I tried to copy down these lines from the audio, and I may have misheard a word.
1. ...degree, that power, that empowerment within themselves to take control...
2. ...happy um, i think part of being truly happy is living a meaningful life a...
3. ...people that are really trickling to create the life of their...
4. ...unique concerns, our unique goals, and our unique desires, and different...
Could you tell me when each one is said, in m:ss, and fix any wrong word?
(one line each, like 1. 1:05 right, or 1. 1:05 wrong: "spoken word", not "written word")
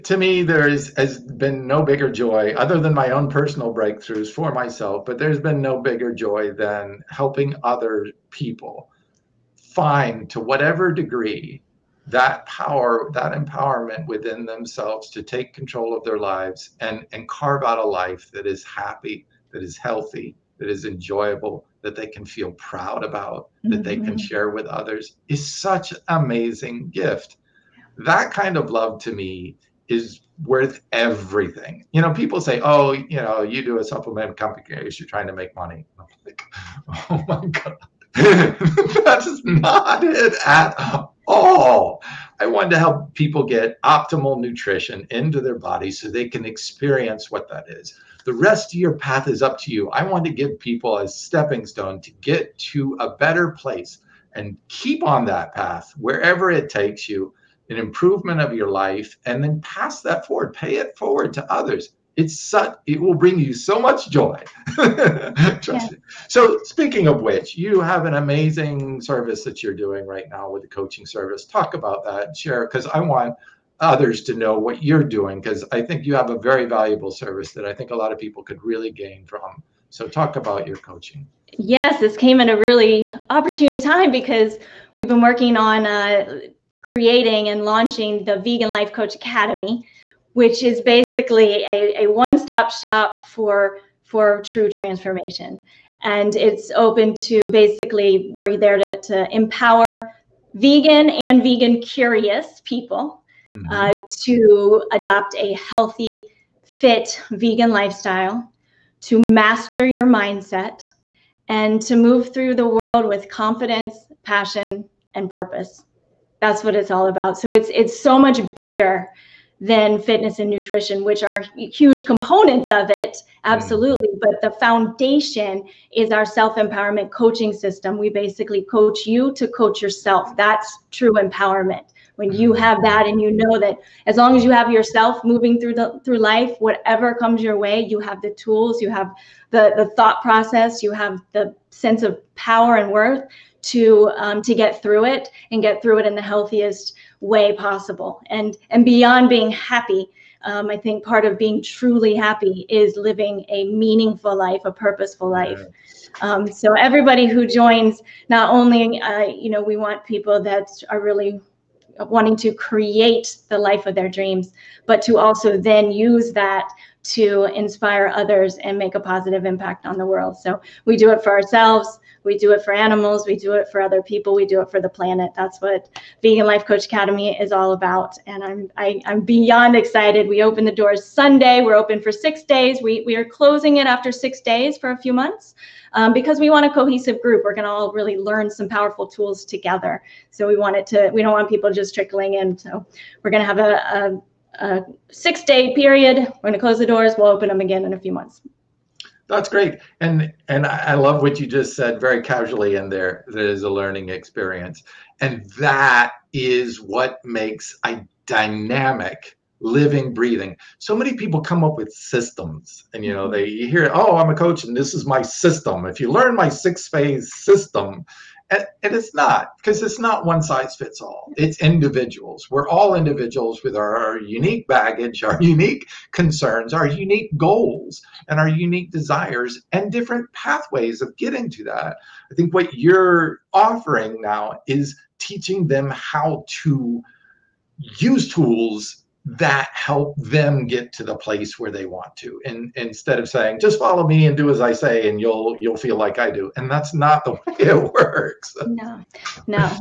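1. 0:10 right
2. 2:29 right
3. 2:40 wrong: "wanting", not "trickling"
4. 3:45 right.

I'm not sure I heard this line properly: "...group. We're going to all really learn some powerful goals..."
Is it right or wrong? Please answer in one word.
wrong.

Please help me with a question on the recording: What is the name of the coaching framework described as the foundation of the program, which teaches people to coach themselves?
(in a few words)
self-empowerment coaching system.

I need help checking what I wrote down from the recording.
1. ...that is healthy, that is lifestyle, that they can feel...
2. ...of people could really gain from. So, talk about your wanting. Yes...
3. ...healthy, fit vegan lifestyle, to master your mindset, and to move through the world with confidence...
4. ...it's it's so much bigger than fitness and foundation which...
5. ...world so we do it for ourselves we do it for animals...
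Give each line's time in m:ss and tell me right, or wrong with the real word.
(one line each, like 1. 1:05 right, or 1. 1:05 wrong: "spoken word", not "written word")
1. 0:19 wrong: "enjoyable", not "lifestyle"
2. 1:18 wrong: "coaching", not "wanting"
3. 1:45 right
4. 1:57 wrong: "nutrition", not "foundation"
5. 2:50 right.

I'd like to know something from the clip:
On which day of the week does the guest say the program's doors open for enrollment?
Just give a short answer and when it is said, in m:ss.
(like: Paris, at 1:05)
Sunday, at 3:01.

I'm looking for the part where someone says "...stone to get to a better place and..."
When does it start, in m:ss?
0:51.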